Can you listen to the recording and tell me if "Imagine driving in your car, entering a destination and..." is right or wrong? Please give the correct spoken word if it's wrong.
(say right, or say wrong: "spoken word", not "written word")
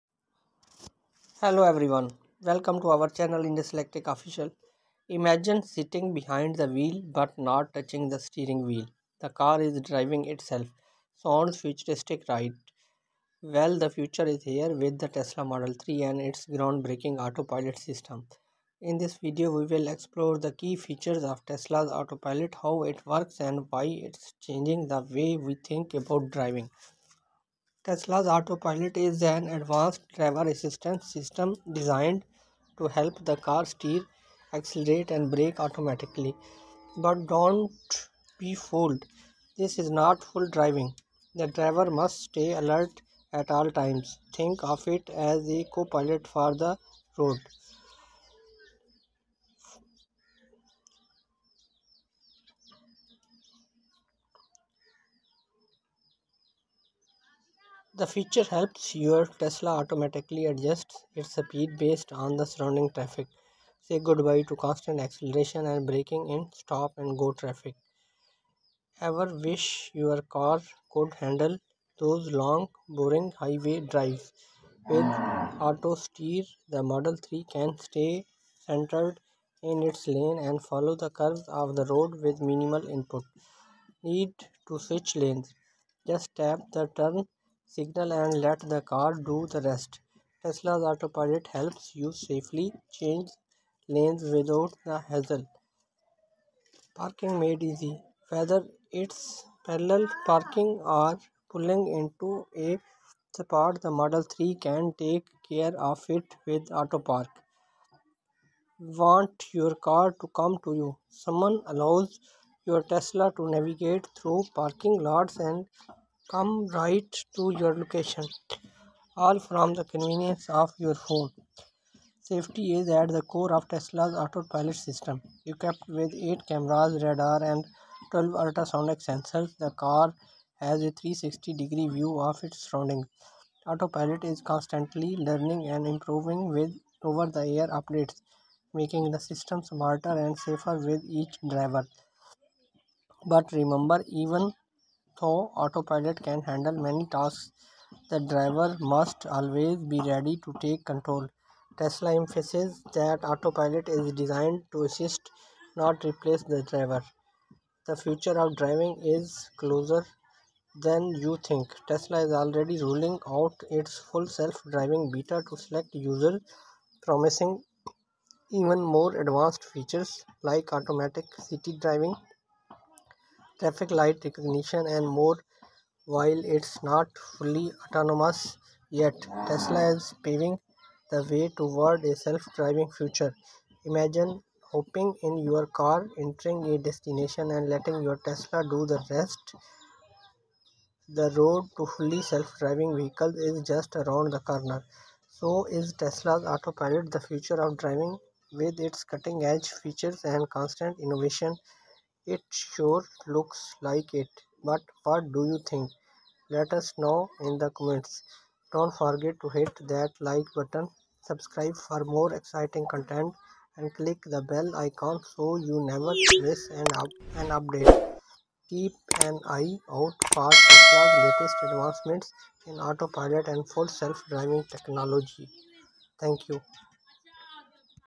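wrong: "hopping", not "driving".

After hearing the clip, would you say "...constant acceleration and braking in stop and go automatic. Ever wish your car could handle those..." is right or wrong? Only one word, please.
wrong.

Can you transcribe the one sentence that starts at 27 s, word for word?
Tesla's autopilot is an advanced driver assistance system designed to help the car steer, accelerate, and brake automatically.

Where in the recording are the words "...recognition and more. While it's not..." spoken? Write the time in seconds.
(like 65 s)
174 s.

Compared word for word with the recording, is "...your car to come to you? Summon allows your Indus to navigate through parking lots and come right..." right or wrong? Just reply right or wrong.
wrong.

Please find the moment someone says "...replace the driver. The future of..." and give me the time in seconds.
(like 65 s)
156 s.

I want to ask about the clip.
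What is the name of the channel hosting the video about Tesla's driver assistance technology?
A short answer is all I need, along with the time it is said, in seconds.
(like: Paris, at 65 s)
Indus Electric Official, at 3 s.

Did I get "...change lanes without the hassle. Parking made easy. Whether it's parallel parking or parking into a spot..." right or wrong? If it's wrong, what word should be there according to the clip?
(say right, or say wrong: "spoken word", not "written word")
wrong: "pulling", not "parking".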